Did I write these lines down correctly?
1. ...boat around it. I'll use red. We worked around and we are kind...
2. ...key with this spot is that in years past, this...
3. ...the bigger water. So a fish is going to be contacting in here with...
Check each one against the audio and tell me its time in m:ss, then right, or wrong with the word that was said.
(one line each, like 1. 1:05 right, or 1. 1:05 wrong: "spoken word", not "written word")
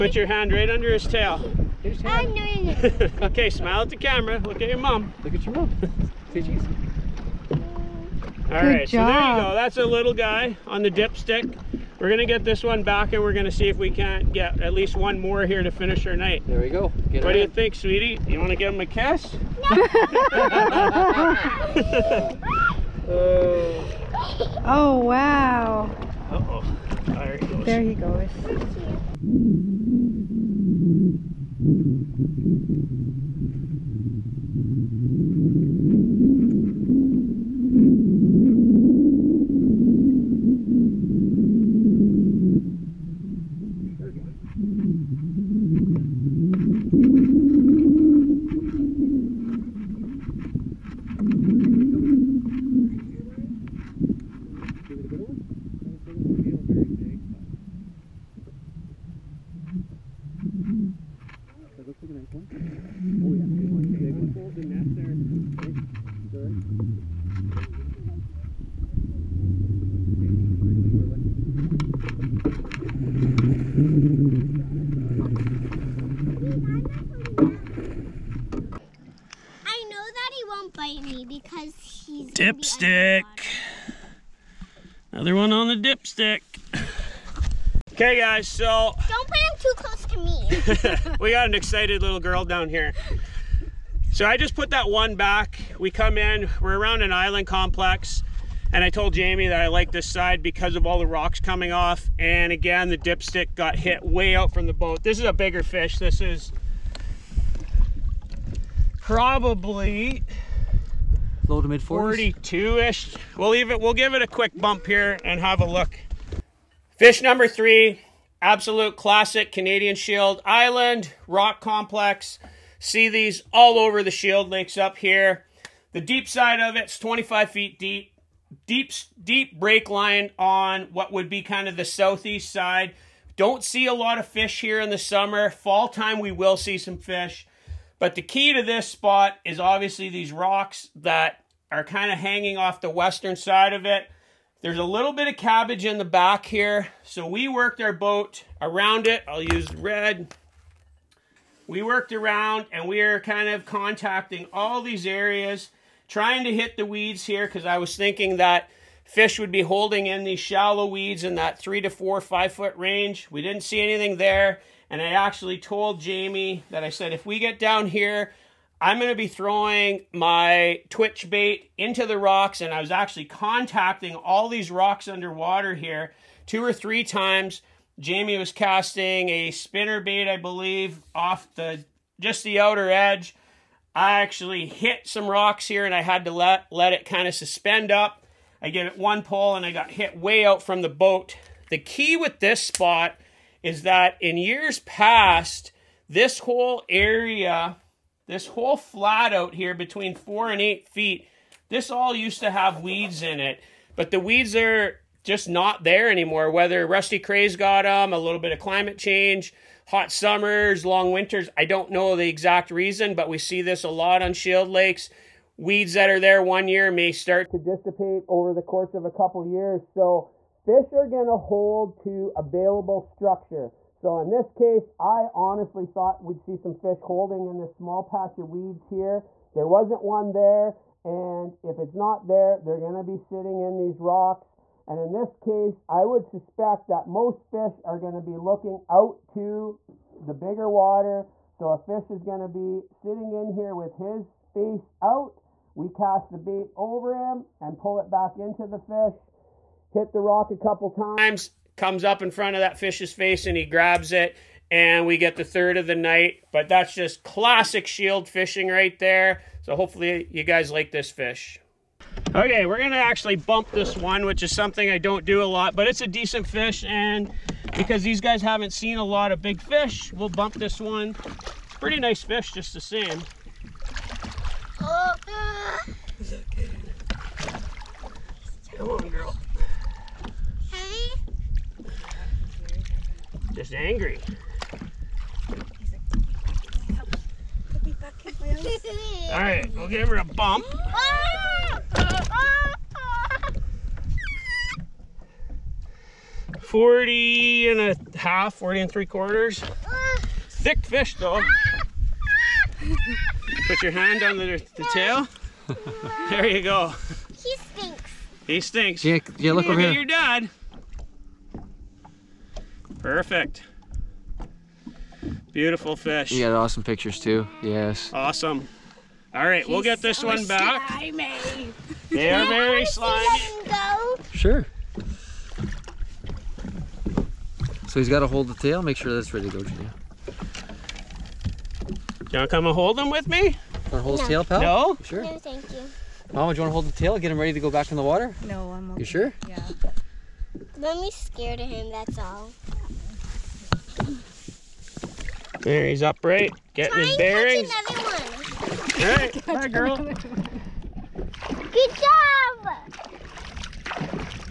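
1. 2:27 right
2. 3:11 right
3. 4:00 wrong: "sitting", not "contacting".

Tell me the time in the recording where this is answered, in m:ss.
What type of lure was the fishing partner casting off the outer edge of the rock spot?
2:59.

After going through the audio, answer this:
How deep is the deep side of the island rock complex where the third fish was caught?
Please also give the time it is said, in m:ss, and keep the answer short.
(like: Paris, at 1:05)
25 feet, at 2:06.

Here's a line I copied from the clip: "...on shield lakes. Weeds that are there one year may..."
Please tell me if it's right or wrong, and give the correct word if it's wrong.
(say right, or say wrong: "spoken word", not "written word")
right.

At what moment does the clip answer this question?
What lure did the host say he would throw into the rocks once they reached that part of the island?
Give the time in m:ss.
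2:50.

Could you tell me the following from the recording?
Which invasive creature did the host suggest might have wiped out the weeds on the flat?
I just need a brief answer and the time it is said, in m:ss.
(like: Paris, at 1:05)
Rusty crays, at 3:26.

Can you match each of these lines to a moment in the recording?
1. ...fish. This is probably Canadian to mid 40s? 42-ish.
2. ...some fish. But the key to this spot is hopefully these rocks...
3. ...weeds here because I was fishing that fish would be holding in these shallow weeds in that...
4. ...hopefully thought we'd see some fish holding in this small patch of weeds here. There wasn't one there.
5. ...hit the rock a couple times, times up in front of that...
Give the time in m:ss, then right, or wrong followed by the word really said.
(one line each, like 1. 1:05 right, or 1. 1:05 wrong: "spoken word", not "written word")
1. 1:45 wrong: "Low", not "Canadian"
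2. 2:16 wrong: "obviously", not "hopefully"
3. 2:36 wrong: "thinking", not "fishing"
4. 3:45 wrong: "honestly", not "hopefully"
5. 4:09 wrong: "comes", not "times".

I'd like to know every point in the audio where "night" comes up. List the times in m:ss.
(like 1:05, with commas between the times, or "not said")
0:16, 4:15.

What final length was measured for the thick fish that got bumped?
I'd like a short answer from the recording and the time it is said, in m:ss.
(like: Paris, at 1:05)
40 and three quarters, at 4:58.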